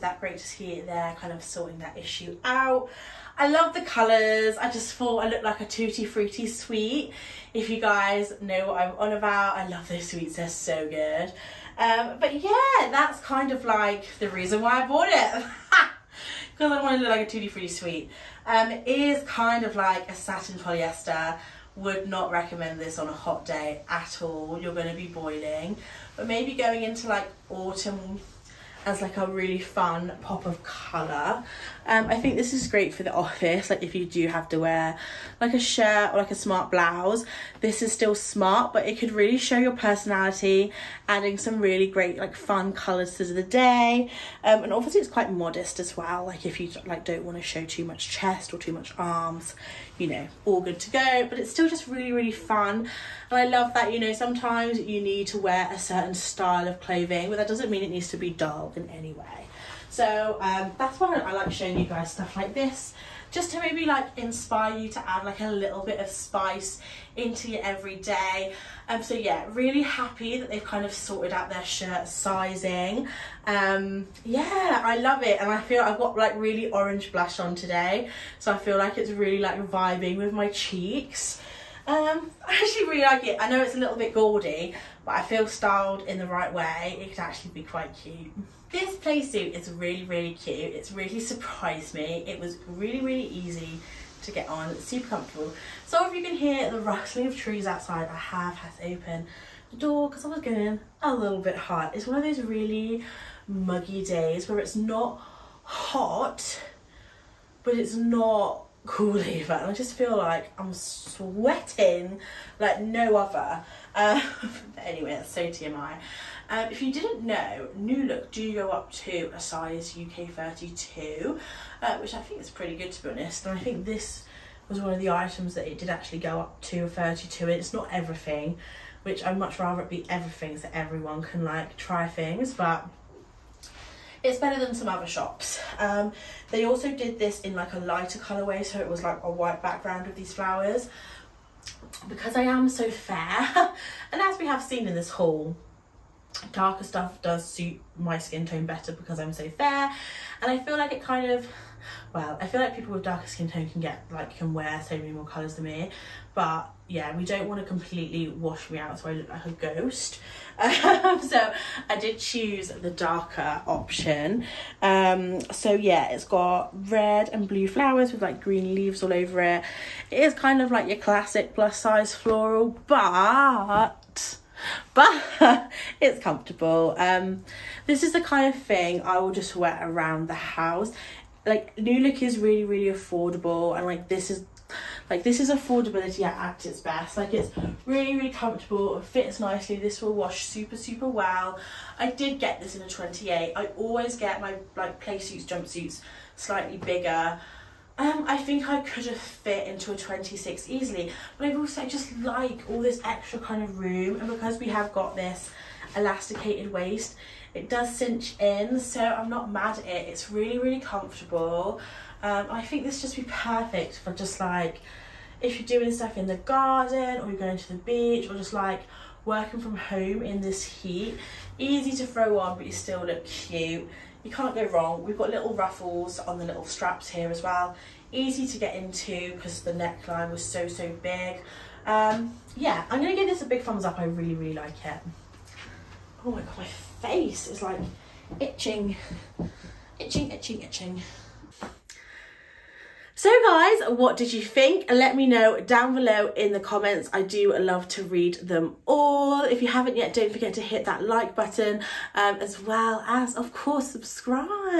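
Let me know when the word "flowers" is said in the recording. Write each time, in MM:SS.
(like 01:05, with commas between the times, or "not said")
02:20, 02:47.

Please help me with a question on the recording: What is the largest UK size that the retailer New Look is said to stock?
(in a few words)
32.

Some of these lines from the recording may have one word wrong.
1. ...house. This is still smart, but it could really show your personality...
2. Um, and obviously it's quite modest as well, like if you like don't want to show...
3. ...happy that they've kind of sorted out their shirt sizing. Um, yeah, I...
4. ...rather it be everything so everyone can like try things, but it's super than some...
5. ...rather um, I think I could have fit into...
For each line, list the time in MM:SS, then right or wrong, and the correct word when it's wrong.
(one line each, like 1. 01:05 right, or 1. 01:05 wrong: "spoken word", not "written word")
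1. 00:36 wrong: "blouse", not "house"
2. 00:44 right
3. 01:09 right
4. 02:09 wrong: "better", not "super"
5. 03:16 wrong: "bigger", not "rather".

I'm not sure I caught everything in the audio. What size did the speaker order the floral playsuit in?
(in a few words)
28.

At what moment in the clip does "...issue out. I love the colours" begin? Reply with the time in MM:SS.
00:01.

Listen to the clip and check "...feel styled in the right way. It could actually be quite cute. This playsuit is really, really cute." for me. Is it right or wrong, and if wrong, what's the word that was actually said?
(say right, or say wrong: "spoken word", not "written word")
right.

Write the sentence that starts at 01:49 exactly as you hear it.
And I just feel like I'm sweating like no other.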